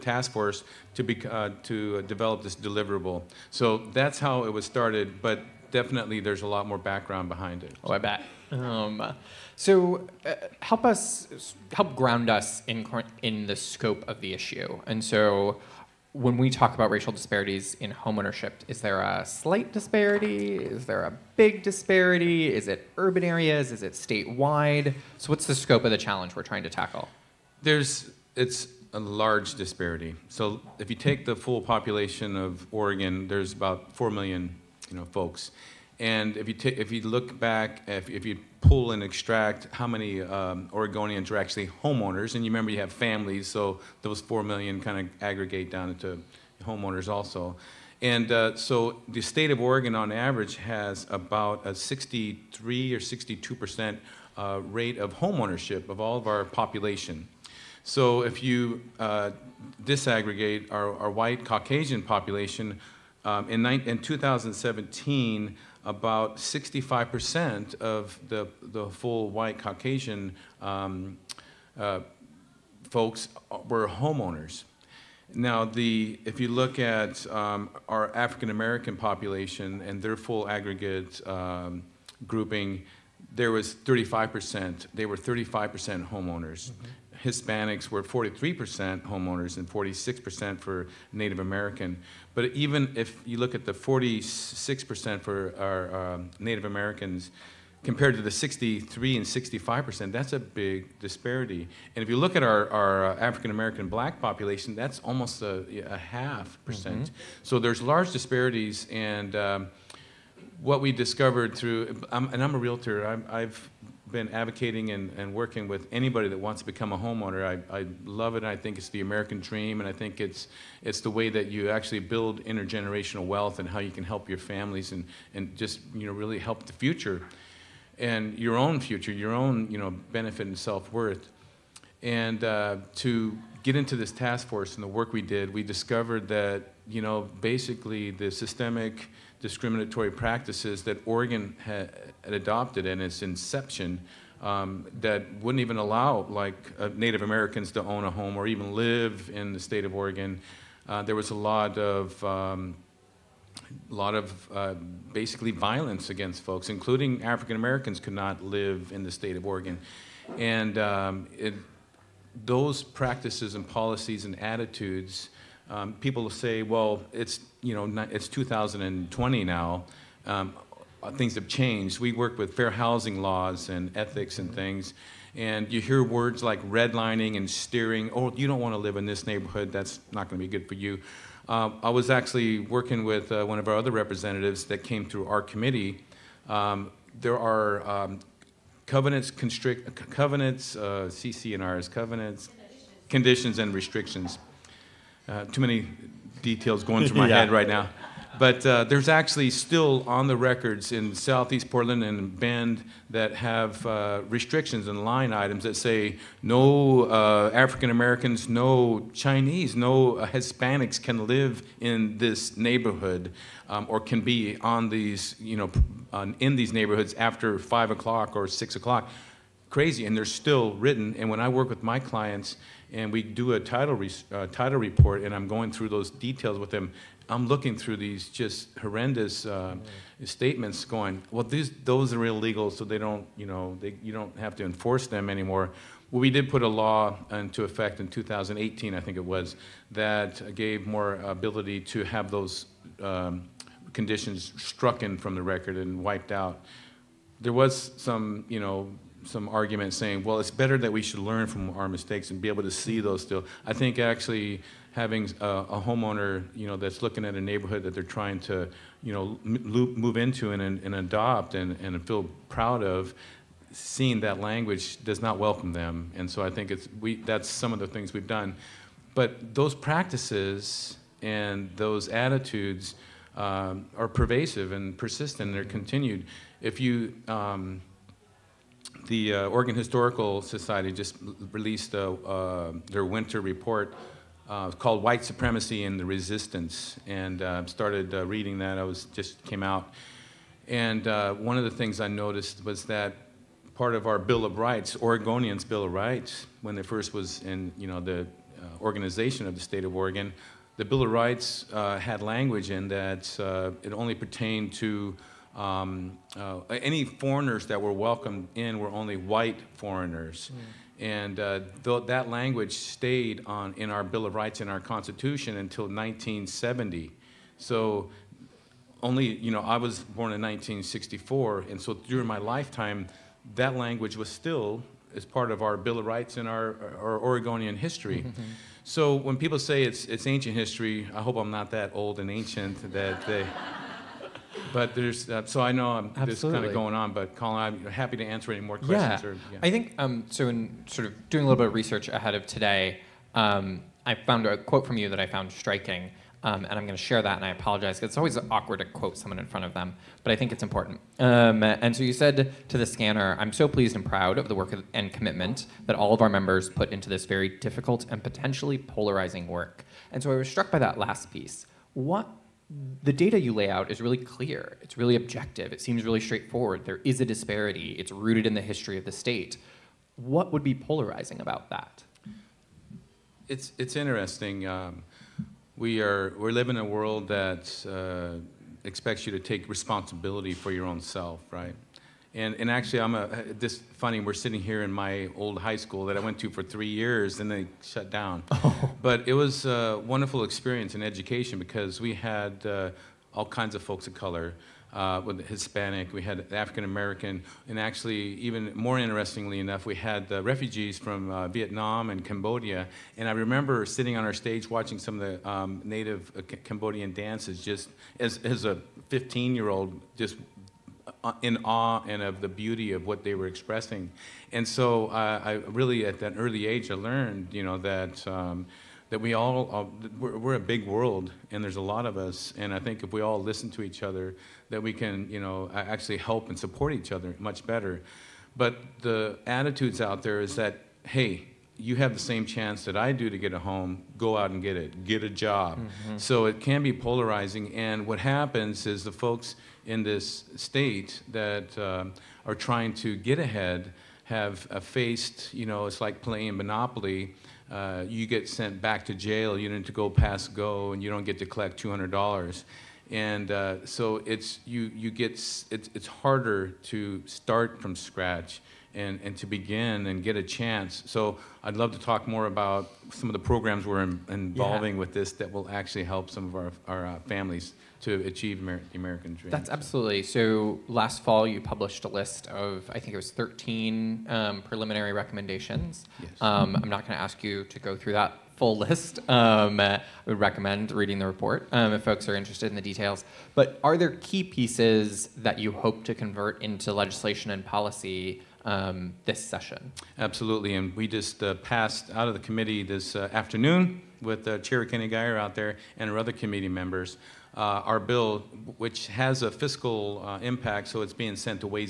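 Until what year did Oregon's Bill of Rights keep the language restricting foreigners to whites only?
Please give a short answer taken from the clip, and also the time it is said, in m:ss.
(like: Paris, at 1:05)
1970, at 5:15.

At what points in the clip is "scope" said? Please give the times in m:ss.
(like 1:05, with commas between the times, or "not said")
0:13, 0:25.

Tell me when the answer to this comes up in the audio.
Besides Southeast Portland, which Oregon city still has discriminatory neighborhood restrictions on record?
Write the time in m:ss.
3:22.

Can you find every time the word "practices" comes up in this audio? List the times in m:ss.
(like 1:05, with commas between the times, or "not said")
2:20, 2:42, 4:29.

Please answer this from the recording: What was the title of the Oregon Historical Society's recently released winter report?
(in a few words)
White Supremacy and the Resistance.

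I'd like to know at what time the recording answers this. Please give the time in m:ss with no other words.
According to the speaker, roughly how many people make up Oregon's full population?
0:33.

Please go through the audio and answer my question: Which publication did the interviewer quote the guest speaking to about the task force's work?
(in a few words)
The Skanner.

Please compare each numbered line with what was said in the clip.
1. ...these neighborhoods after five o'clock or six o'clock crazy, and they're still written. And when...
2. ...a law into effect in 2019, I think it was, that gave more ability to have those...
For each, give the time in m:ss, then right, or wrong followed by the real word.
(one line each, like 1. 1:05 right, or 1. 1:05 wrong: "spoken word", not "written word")
1. 3:36 right
2. 3:56 wrong: "2018", not "2019".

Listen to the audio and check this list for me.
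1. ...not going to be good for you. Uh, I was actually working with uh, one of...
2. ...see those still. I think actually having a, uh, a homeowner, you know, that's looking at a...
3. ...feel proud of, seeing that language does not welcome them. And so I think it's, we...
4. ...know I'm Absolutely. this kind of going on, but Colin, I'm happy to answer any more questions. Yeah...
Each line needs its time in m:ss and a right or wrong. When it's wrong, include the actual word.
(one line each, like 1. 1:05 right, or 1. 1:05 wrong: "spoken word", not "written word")
1. 3:00 right
2. 4:12 right
3. 4:22 right
4. 5:35 right.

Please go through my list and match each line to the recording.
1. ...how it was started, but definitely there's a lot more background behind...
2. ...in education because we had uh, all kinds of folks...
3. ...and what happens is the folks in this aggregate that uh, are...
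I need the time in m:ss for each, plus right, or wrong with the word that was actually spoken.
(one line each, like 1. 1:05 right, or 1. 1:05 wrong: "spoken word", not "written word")
1. 0:04 right
2. 6:30 right
3. 7:17 wrong: "state", not "aggregate".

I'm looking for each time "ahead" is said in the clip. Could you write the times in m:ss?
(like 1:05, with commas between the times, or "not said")
5:42, 7:23.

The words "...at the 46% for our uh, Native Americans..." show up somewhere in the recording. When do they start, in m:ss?
1:33.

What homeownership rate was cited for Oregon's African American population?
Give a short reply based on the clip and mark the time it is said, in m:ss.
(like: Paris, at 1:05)
35%, at 1:24.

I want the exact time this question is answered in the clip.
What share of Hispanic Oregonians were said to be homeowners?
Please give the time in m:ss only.
1:27.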